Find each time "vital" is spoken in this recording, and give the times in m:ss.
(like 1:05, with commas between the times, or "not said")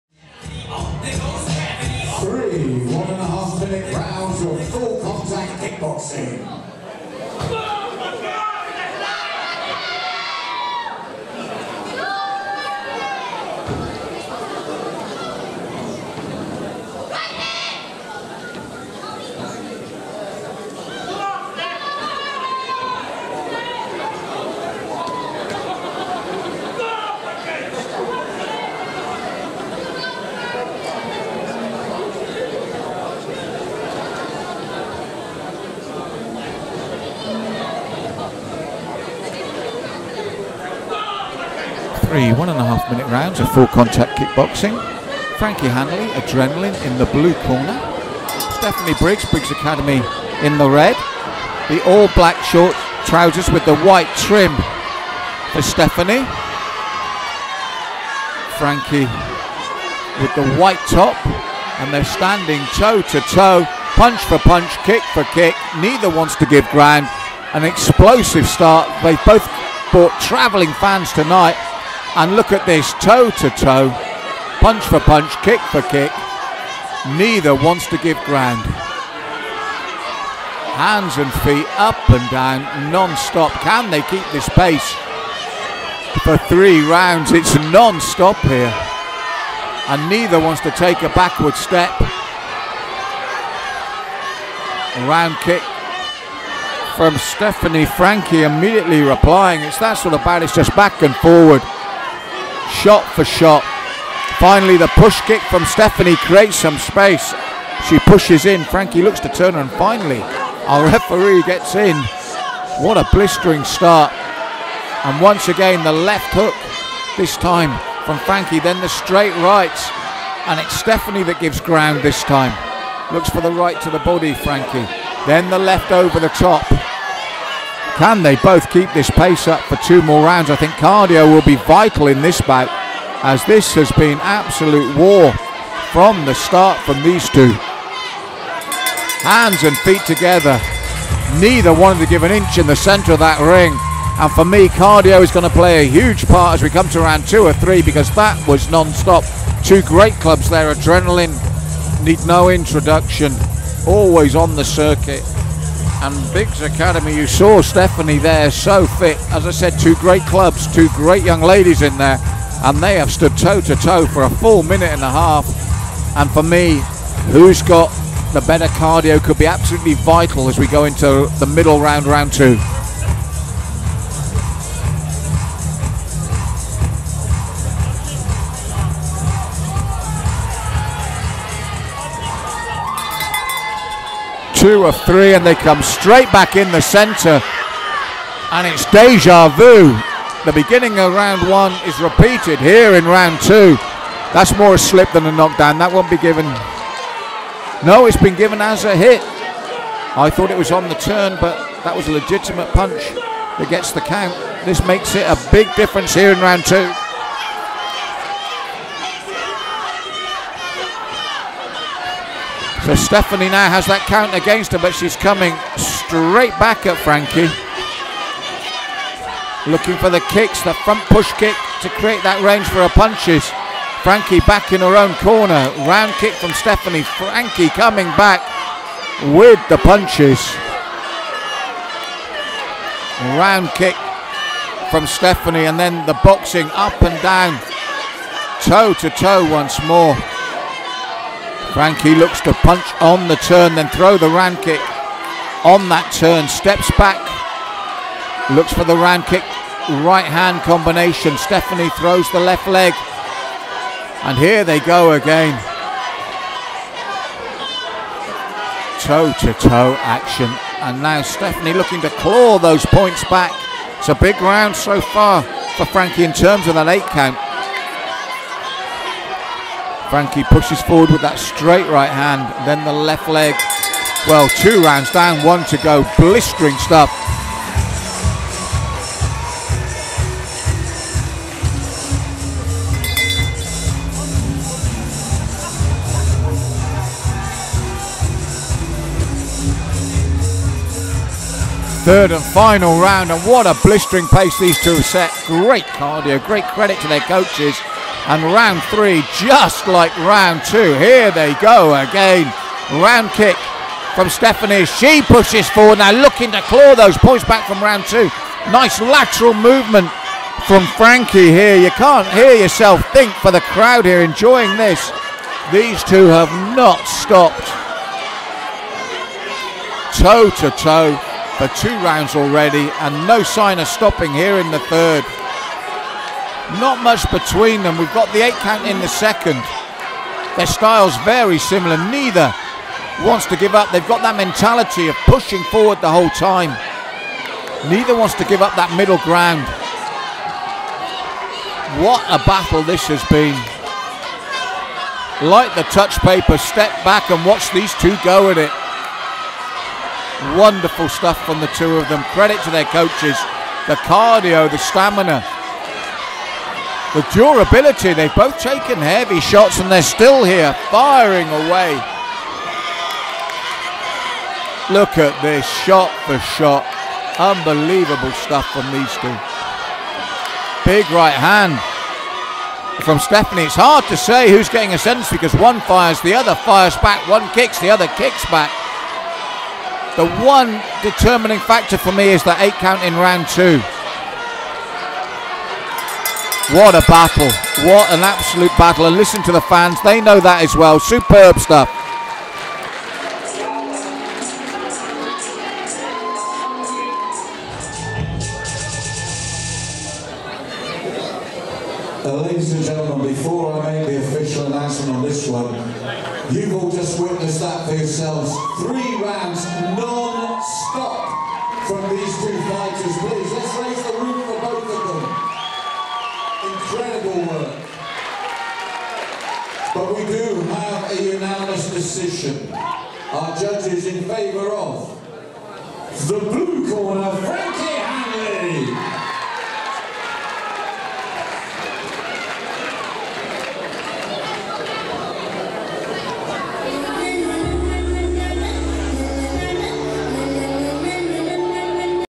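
2:11, 2:49.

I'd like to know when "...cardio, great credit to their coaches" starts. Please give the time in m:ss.
4:55.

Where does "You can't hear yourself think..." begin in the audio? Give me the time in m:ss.
5:11.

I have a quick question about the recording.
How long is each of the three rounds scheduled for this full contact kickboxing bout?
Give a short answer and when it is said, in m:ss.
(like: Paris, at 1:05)
1.5 minutes, at 0:42.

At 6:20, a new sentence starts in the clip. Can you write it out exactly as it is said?
The one determining factor for me is the eight count in round two.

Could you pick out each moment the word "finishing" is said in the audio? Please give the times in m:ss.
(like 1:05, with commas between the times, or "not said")
not said.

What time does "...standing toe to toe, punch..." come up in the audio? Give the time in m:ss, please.
1:02.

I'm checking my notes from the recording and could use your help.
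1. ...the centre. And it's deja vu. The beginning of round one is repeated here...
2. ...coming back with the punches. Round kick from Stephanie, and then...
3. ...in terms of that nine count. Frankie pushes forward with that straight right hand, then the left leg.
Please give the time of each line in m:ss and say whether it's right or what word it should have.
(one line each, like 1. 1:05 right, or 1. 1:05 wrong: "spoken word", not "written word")
1. 3:06 right
2. 3:47 right
3. 4:26 wrong: "eight", not "nine".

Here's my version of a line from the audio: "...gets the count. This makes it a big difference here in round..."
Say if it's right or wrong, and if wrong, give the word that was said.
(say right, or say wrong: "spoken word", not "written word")
right.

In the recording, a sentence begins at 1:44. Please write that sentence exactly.
Finally, the push kick from Stephanie creates some space.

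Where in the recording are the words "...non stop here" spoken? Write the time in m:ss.
1:27.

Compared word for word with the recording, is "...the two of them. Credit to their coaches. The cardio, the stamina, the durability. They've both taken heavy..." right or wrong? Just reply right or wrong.
right.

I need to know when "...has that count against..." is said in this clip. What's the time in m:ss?
3:33.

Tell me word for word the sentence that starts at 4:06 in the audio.
Steps back, looks for the round kick, right hand combination.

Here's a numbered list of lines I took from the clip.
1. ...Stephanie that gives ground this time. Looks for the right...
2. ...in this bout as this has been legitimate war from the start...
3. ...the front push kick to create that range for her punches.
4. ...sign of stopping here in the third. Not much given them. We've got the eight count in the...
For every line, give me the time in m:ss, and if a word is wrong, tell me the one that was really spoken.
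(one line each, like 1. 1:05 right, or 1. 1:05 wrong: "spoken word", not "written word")
1. 2:00 right
2. 2:12 wrong: "absolute", not "legitimate"
3. 3:40 right
4. 5:23 wrong: "between", not "given".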